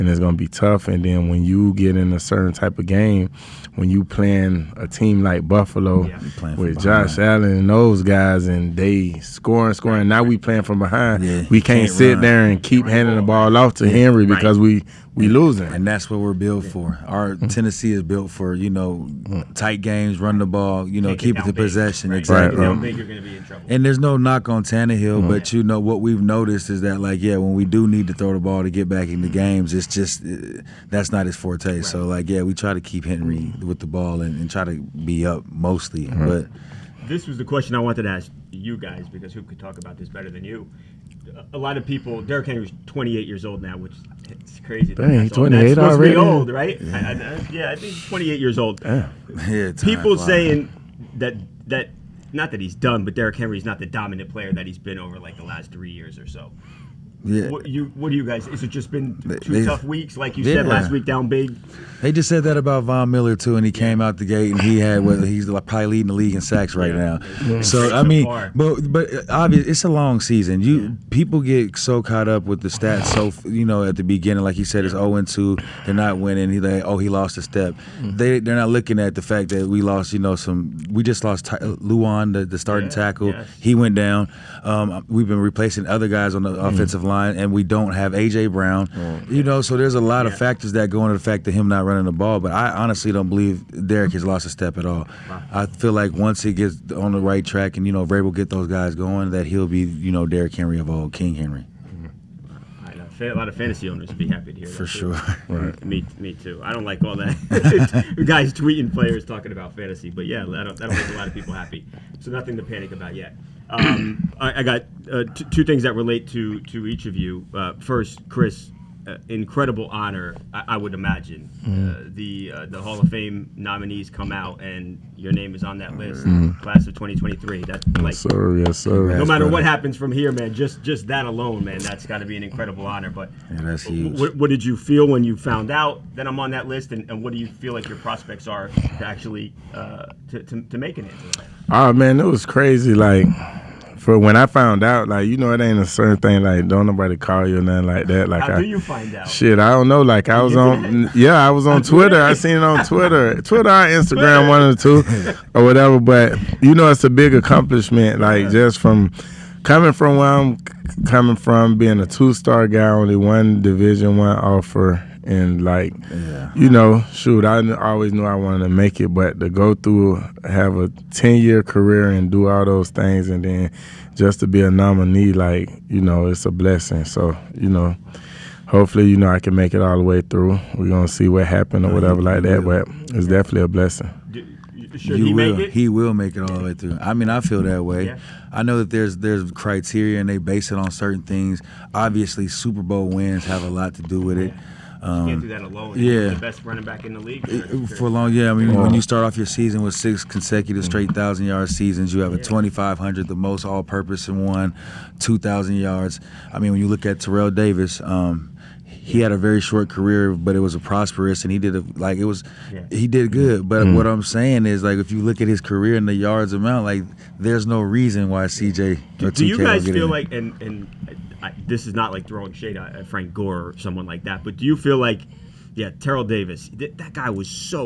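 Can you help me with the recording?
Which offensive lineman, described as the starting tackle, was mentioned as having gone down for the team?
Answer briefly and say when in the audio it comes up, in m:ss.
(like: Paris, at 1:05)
Lewan, at 1:21.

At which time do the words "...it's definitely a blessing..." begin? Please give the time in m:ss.
3:03.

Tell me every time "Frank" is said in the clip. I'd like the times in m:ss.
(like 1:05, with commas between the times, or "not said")
3:43.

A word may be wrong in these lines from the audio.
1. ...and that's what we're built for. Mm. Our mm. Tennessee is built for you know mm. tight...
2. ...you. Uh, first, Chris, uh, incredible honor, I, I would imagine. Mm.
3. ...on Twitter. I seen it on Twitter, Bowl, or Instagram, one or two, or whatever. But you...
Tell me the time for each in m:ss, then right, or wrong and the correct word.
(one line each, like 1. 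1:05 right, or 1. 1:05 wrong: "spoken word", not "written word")
1. 0:15 right
2. 1:57 right
3. 2:31 wrong: "Twitter", not "Bowl".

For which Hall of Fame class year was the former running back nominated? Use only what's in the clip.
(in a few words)
2023.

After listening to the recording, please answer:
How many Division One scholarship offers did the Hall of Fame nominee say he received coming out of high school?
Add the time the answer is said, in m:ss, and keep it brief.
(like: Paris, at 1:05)
1, at 2:42.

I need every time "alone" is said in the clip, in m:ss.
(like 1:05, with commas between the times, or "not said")
2:11, 3:15.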